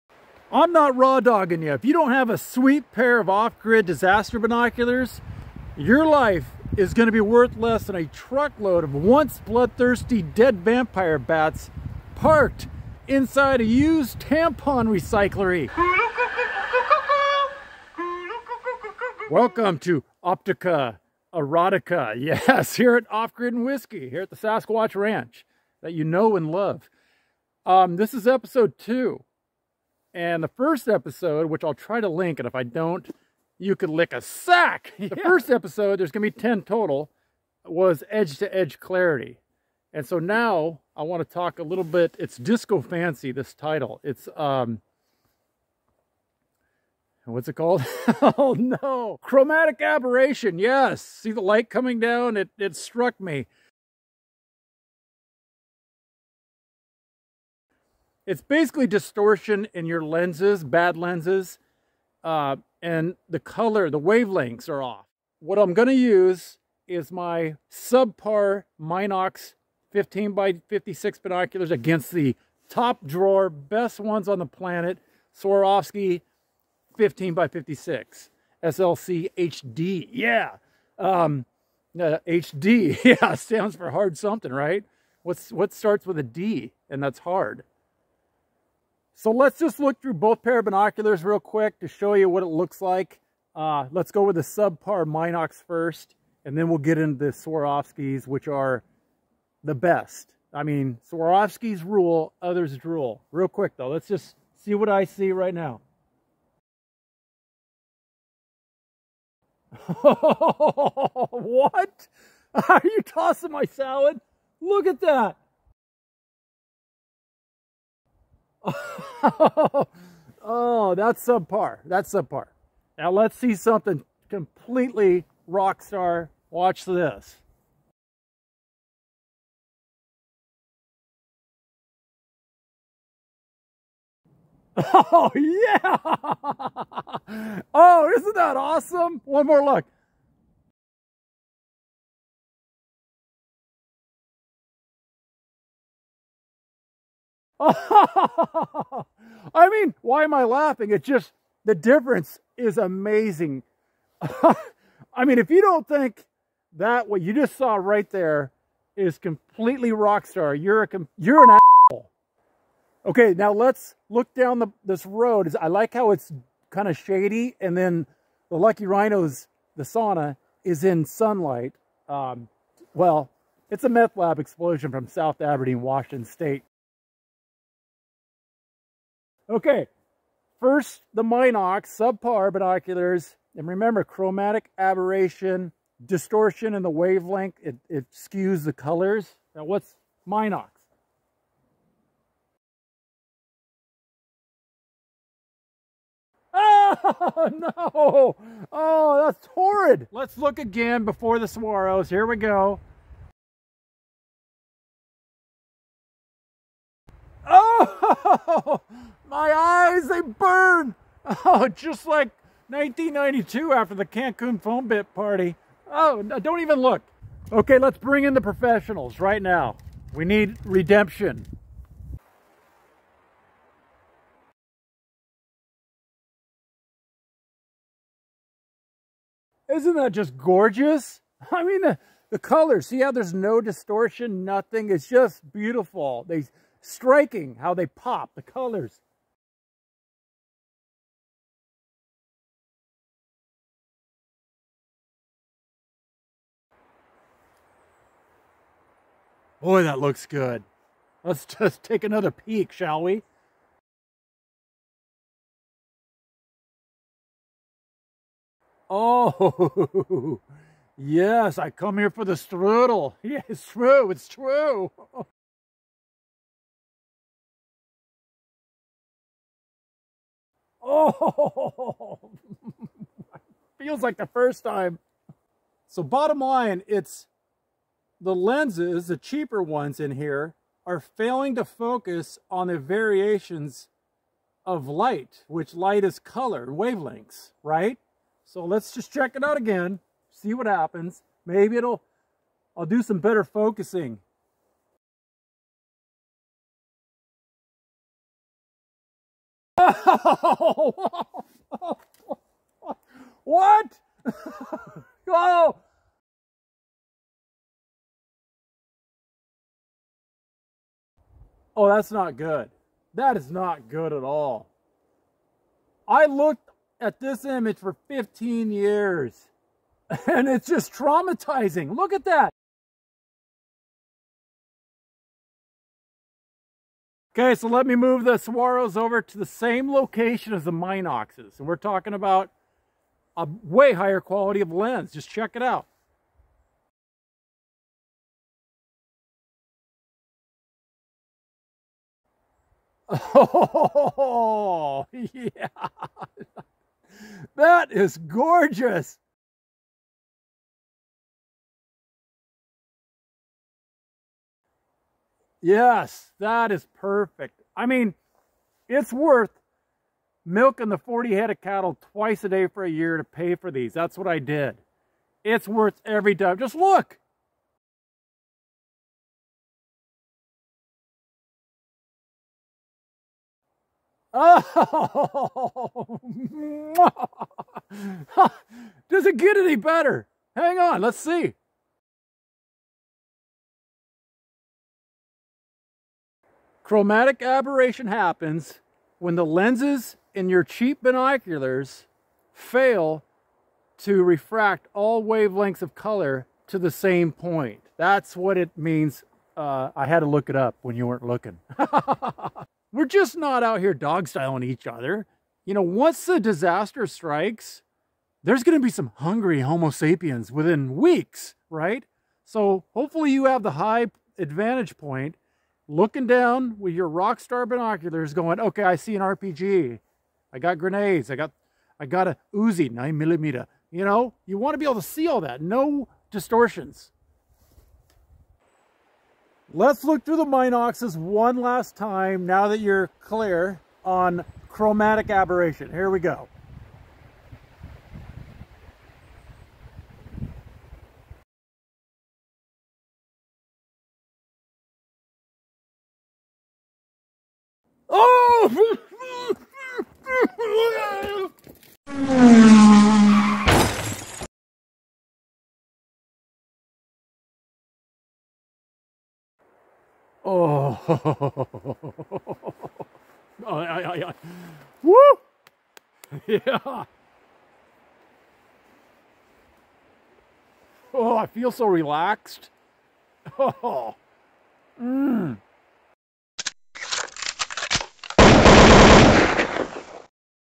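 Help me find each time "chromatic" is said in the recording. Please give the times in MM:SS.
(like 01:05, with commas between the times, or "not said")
00:49, 03:04, 06:26, 07:14.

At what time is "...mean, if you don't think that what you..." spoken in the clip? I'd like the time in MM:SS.
02:35.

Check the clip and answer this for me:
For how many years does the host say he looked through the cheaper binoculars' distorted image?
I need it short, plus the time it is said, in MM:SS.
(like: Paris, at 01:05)
15 years, at 05:18.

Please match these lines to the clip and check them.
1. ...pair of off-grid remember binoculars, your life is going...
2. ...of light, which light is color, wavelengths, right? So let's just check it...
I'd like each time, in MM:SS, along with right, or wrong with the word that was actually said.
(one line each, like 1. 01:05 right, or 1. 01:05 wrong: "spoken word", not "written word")
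1. 00:02 wrong: "disaster", not "remember"
2. 04:44 right.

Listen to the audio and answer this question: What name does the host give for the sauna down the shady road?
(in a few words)
Lucky Rhinos.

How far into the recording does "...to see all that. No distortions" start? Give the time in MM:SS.
07:04.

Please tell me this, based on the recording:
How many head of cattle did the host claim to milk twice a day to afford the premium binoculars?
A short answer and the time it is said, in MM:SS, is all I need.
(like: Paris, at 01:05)
40, at 06:00.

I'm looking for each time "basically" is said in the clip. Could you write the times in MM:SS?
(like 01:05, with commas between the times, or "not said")
00:58.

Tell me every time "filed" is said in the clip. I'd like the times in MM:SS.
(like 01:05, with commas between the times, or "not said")
not said.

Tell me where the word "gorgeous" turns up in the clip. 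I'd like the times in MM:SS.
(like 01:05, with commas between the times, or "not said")
03:50, 05:48.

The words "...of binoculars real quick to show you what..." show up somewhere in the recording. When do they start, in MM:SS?
01:30.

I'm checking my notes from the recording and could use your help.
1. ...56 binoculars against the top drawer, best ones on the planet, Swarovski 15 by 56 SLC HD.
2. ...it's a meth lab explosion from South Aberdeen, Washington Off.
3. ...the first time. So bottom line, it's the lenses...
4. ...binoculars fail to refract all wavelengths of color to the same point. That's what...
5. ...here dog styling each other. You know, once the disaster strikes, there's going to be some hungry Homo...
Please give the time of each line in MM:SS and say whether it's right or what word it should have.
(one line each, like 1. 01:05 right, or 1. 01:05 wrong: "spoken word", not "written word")
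1. 01:10 right
2. 02:53 wrong: "State", not "Off"
3. 04:34 right
4. 06:31 right
5. 06:43 right.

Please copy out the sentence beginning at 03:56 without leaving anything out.
They striking how they pop, the colors.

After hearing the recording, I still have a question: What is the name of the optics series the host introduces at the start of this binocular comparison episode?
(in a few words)
Optica Erotica.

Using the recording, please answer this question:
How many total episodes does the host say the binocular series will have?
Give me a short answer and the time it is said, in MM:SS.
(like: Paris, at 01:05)
10, at 00:36.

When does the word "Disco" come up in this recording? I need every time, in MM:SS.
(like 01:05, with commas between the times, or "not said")
00:42.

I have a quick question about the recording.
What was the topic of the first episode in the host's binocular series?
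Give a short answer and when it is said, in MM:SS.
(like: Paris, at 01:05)
edge to edge clarity, at 00:38.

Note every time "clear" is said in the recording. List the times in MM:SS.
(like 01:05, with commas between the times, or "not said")
07:13.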